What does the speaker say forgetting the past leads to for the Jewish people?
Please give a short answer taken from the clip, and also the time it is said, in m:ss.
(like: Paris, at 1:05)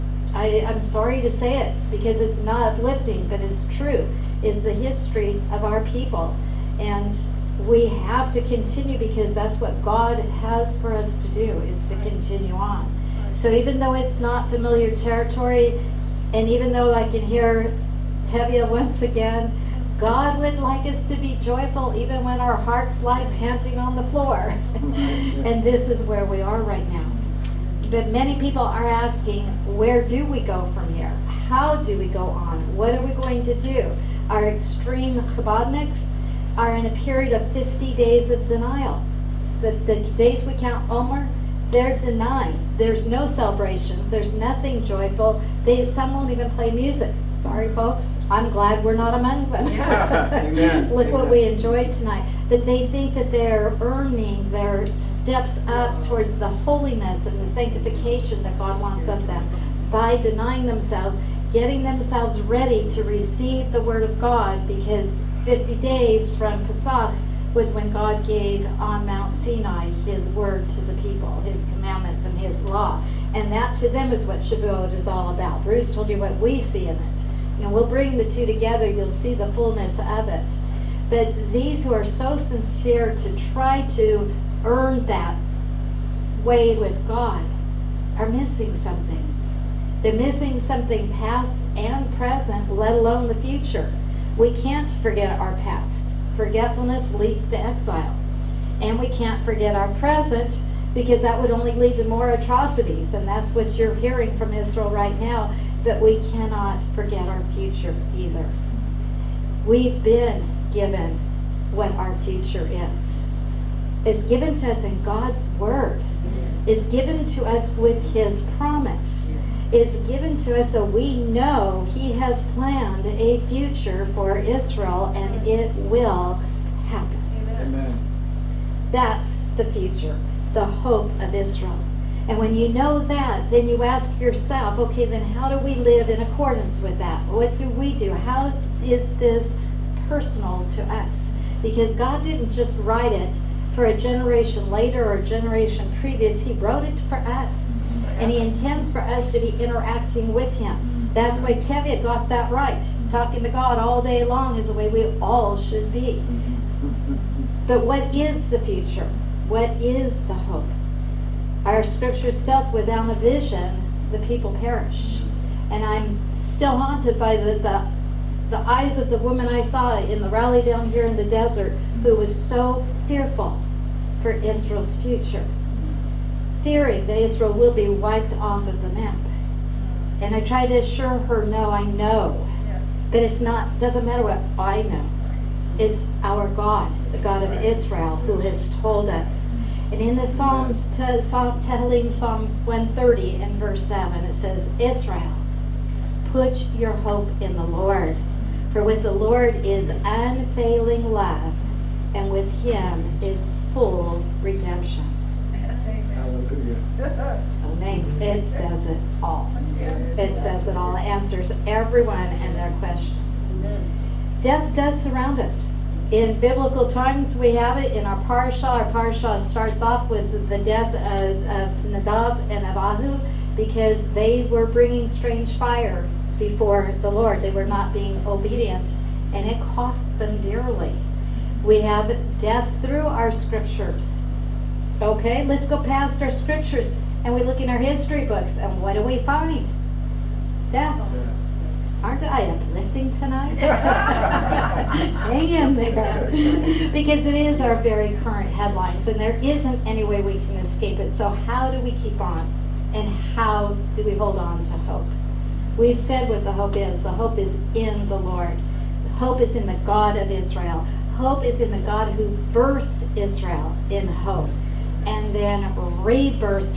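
Exile, at 1:37.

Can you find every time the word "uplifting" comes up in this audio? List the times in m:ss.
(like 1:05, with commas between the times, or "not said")
0:02, 4:02.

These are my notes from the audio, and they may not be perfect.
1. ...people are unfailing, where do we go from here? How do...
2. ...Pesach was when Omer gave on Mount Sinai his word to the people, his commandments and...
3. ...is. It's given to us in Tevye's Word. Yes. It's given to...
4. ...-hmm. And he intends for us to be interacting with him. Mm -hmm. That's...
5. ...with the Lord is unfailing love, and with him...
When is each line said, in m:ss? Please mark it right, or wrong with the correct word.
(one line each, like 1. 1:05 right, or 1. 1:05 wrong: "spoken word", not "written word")
1. 0:28 wrong: "asking", not "unfailing"
2. 1:06 wrong: "God", not "Omer"
3. 1:52 wrong: "God", not "Tevye"
4. 2:27 right
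5. 3:18 right.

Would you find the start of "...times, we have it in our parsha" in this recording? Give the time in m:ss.
3:36.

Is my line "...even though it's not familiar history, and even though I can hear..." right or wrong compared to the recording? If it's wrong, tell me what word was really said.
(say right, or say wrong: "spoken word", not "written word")
wrong: "territory", not "history".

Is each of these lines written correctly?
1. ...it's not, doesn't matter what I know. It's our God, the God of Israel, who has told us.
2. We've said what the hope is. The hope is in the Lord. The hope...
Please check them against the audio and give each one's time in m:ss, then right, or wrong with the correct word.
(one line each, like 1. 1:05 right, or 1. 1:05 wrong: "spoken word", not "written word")
1. 3:03 right
2. 4:15 right.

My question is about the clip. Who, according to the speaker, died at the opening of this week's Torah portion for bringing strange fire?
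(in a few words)
Nadab and Abihu.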